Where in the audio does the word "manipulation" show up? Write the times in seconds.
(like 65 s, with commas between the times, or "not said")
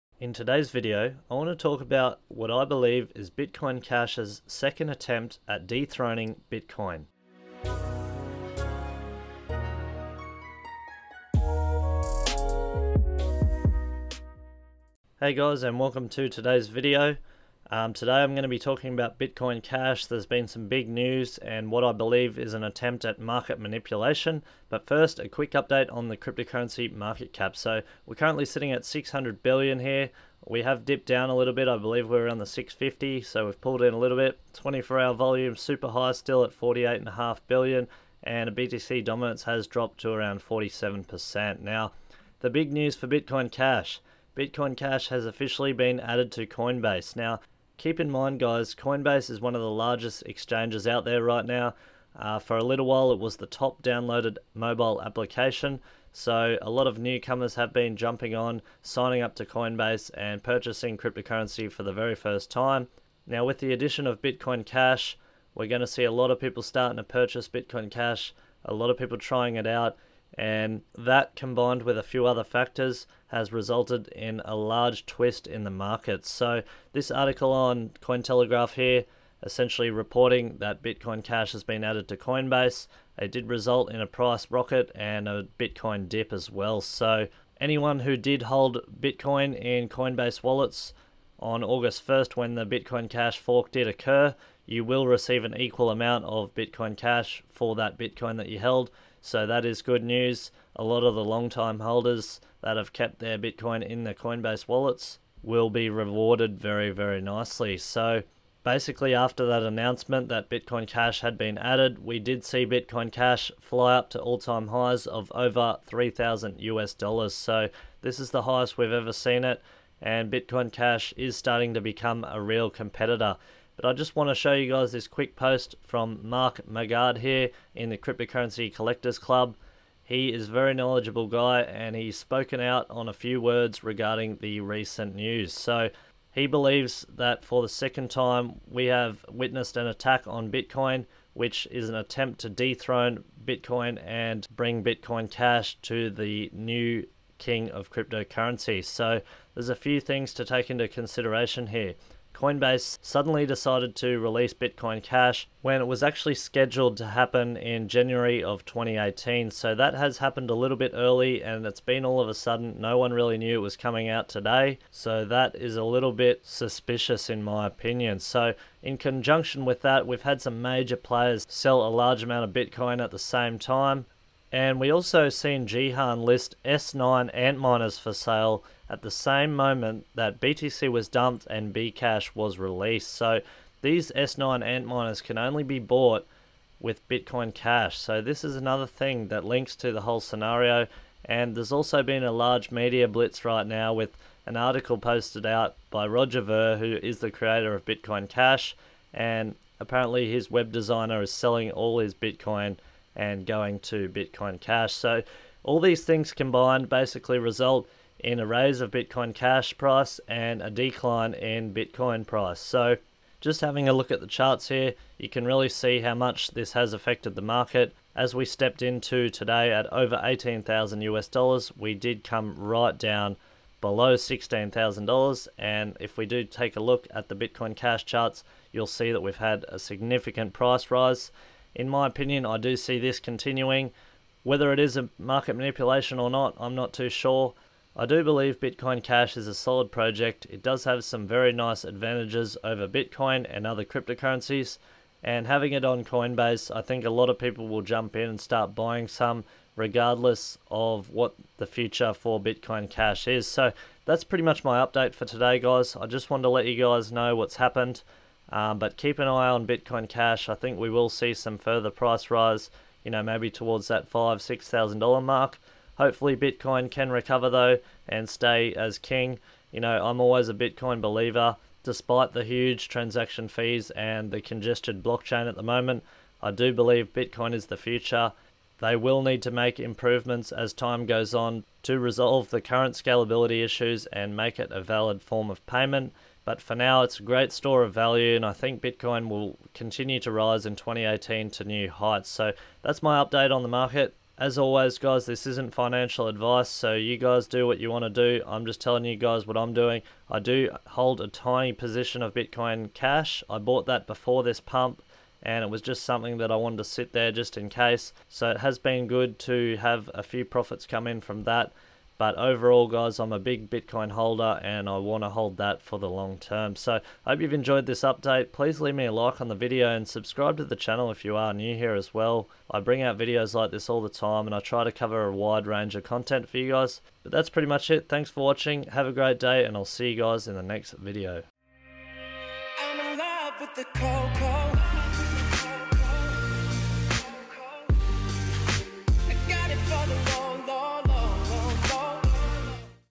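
23 s, 235 s.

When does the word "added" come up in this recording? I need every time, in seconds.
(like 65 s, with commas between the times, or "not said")
46 s, 81 s, 111 s.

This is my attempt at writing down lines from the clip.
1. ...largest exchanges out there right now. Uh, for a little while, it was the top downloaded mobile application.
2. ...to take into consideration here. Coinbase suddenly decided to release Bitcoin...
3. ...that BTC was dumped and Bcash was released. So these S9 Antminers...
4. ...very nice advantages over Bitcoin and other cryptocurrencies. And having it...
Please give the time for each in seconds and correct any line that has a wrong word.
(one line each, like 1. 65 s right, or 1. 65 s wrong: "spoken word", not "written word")
1. 49 s right
2. 150 s right
3. 180 s right
4. 241 s right.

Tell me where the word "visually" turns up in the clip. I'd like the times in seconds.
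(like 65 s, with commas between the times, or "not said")
not said.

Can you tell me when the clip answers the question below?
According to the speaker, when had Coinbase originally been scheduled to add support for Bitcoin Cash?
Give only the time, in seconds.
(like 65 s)
157 s.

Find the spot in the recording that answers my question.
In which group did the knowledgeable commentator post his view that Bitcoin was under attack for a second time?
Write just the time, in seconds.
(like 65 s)
127 s.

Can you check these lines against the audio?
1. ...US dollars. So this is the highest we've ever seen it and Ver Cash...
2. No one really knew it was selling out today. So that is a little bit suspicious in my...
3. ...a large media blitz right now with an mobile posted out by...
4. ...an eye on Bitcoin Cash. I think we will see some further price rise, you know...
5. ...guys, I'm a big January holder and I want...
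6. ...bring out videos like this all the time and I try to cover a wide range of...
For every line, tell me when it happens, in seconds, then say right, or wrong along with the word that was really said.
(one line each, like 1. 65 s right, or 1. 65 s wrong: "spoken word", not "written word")
1. 116 s wrong: "Bitcoin", not "Ver"
2. 162 s wrong: "coming", not "selling"
3. 192 s wrong: "article", not "mobile"
4. 259 s right
5. 312 s wrong: "Bitcoin", not "January"
6. 322 s right.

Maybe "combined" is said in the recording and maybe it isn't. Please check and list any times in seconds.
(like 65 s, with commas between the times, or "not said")
71 s, 206 s.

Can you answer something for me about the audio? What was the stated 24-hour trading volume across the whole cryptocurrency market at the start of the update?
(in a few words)
48.5 billion.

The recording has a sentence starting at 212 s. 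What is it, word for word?
So just having a look at the charts here, you can really see how much this has affected the market.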